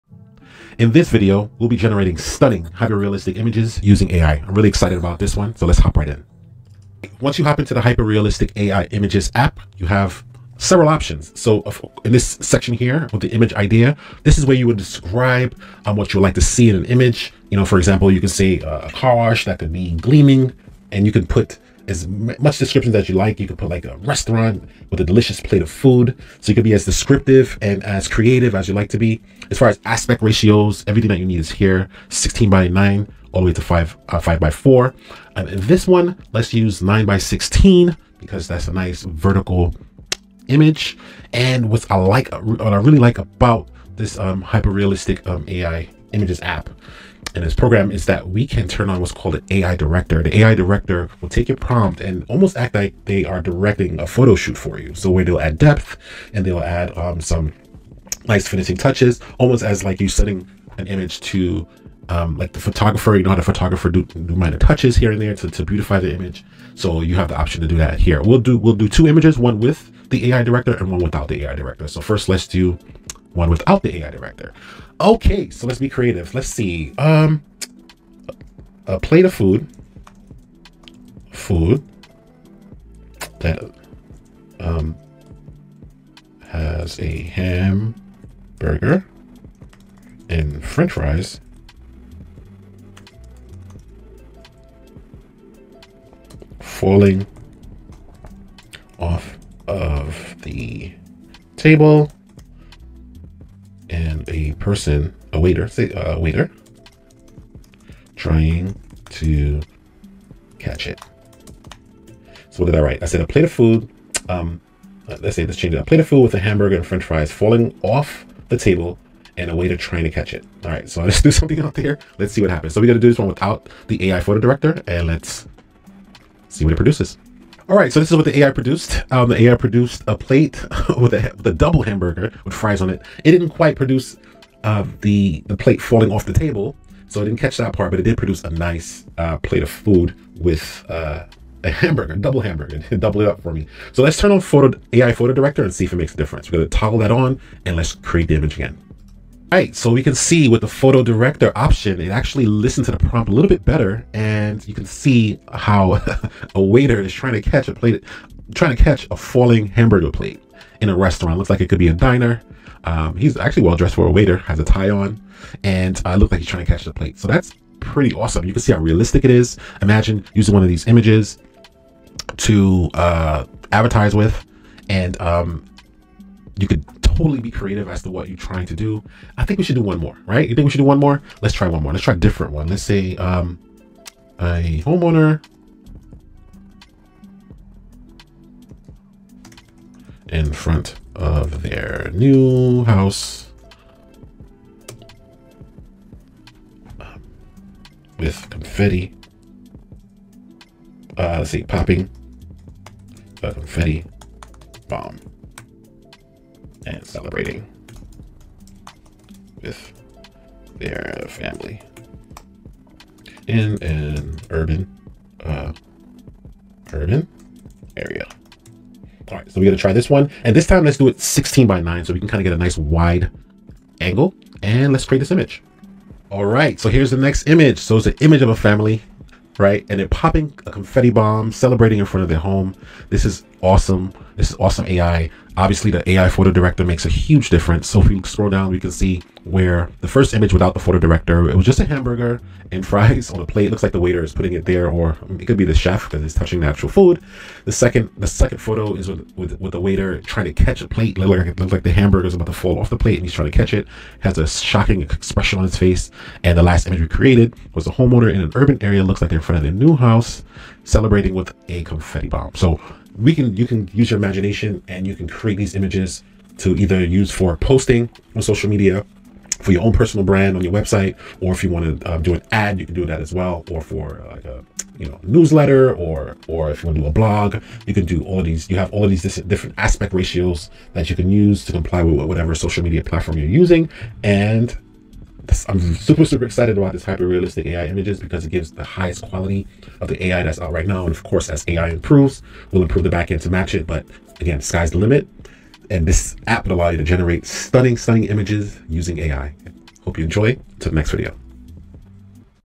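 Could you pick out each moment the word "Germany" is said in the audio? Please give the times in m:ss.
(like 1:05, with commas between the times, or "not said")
not said.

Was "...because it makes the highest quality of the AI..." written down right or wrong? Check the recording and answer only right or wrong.
wrong.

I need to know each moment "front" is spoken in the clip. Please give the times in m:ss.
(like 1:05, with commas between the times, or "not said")
3:10, 3:52, 4:19.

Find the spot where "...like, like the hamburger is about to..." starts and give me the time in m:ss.
4:11.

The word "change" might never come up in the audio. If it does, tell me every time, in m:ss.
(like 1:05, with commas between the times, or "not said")
1:55.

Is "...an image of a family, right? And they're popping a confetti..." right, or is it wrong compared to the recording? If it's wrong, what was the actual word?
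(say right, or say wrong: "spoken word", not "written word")
right.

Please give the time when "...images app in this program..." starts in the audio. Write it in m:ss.
0:46.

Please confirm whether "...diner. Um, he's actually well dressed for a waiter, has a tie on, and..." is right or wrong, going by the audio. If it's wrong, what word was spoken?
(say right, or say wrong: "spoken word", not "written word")
right.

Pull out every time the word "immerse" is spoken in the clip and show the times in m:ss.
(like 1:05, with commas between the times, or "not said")
not said.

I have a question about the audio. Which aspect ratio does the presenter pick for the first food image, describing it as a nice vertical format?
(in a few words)
9 by 16.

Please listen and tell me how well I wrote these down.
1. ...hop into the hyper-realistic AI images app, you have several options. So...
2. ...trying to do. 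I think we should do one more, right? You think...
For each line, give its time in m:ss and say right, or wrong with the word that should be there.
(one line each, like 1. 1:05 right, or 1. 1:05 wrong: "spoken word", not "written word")
1. 0:07 right
2. 2:58 right.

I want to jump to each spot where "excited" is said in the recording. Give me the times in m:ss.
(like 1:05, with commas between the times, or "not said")
0:04, 4:46.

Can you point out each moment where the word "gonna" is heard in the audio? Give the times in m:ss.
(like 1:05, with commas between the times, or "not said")
2:26, 3:39.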